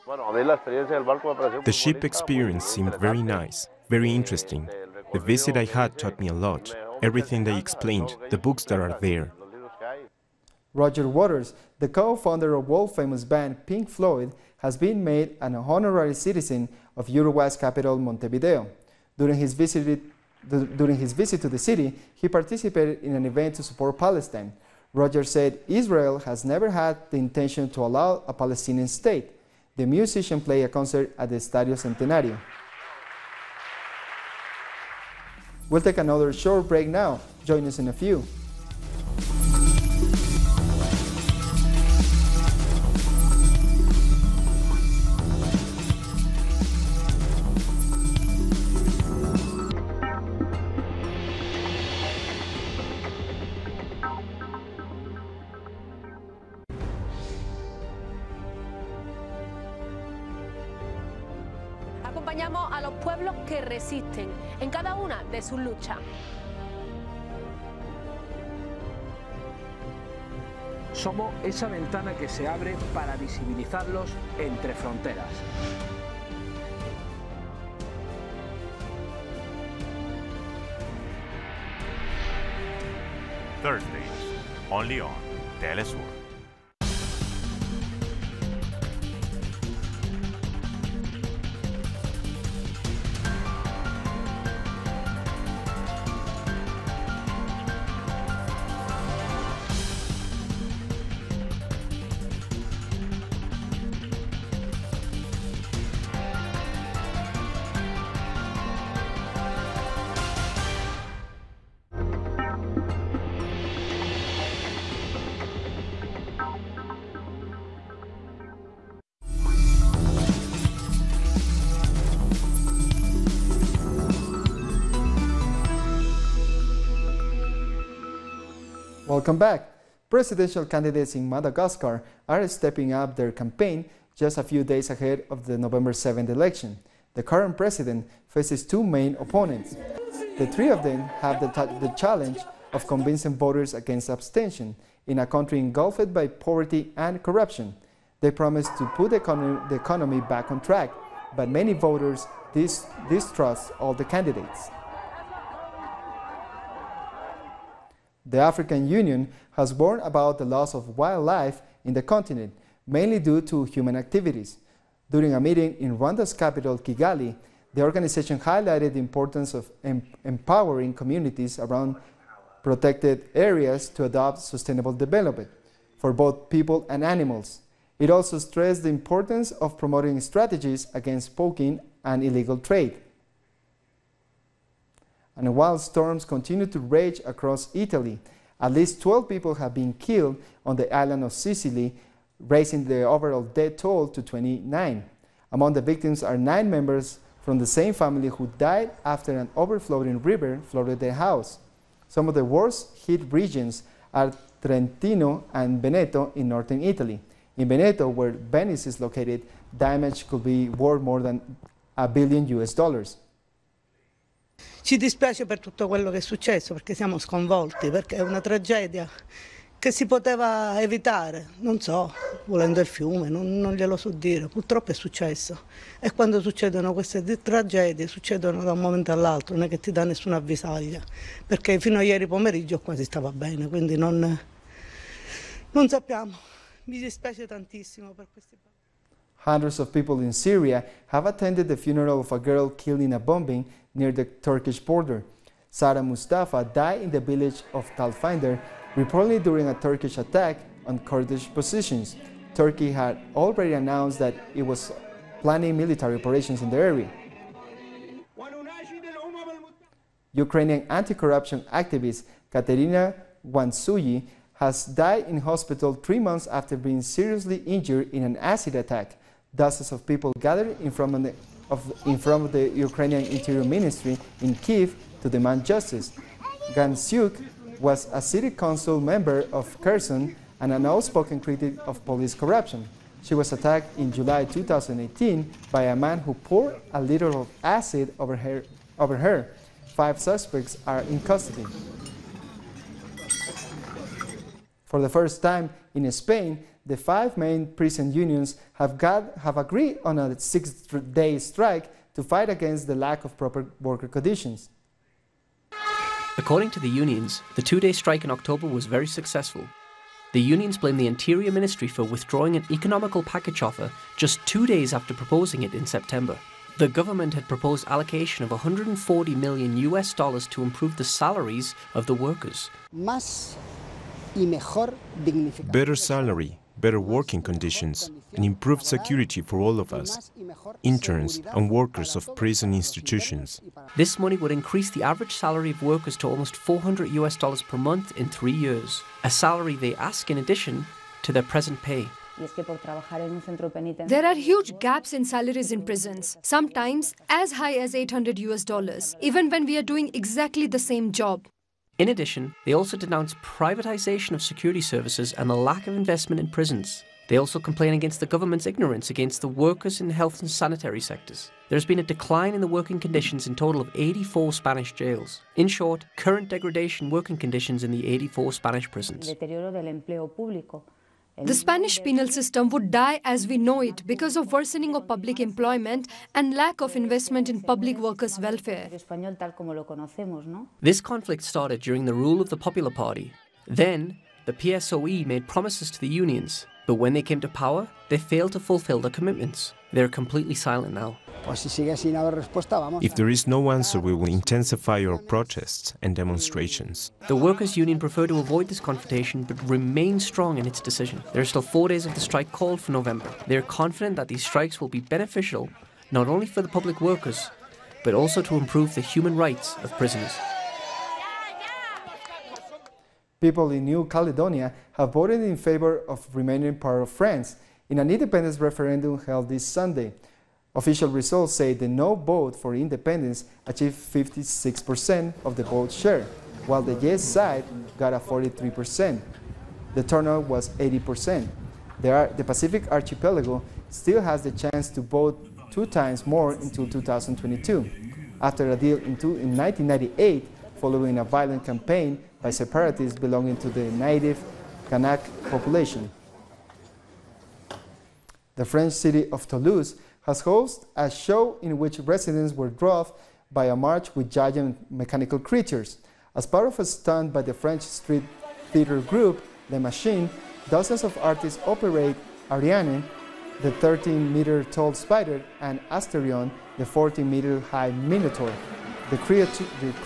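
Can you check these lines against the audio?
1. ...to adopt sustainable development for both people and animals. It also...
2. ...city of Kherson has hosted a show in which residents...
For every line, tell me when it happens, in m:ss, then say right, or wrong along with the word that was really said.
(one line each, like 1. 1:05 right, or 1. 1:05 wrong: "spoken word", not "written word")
1. 2:53 right
2. 7:28 wrong: "Toulouse", not "Kherson".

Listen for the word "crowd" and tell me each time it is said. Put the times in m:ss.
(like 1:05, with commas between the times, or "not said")
not said.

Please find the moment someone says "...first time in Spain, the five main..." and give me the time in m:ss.
4:55.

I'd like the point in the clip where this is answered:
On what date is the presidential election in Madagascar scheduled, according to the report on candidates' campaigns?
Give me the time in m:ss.
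2:15.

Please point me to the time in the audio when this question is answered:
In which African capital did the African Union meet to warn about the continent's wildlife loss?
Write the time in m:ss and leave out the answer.
2:46.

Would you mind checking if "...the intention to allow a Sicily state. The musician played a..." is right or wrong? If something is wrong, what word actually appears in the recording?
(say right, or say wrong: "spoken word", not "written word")
wrong: "Palestinian", not "Sicily".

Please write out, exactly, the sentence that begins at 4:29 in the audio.
Dozens of people gathered in front of the, of, in front of the Ukrainian Interior Ministry in Kiev to demand justice.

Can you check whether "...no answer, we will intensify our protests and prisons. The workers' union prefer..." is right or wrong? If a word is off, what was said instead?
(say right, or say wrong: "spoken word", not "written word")
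wrong: "demonstrations", not "prisons".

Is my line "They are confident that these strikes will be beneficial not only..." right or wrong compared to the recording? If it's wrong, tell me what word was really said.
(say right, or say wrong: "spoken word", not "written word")
right.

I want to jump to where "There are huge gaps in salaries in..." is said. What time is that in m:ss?
5:44.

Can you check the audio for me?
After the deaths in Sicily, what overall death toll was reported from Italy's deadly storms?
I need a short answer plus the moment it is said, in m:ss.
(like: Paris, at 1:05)
29, at 3:14.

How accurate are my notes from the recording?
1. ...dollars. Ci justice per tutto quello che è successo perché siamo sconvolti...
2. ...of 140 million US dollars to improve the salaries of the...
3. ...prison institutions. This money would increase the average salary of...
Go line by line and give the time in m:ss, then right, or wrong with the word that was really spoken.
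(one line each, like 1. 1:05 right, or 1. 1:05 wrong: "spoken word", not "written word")
1. 3:32 wrong: "dispiace", not "justice"
2. 5:18 right
3. 5:32 right.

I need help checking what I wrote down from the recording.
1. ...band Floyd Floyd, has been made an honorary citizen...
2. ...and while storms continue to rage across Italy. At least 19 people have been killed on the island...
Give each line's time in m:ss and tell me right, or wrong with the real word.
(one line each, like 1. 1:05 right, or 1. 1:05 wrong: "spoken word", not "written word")
1. 0:13 wrong: "Pink", not "Floyd"
2. 3:05 wrong: "12", not "19".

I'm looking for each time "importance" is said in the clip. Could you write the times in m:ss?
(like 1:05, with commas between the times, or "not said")
2:48, 2:58.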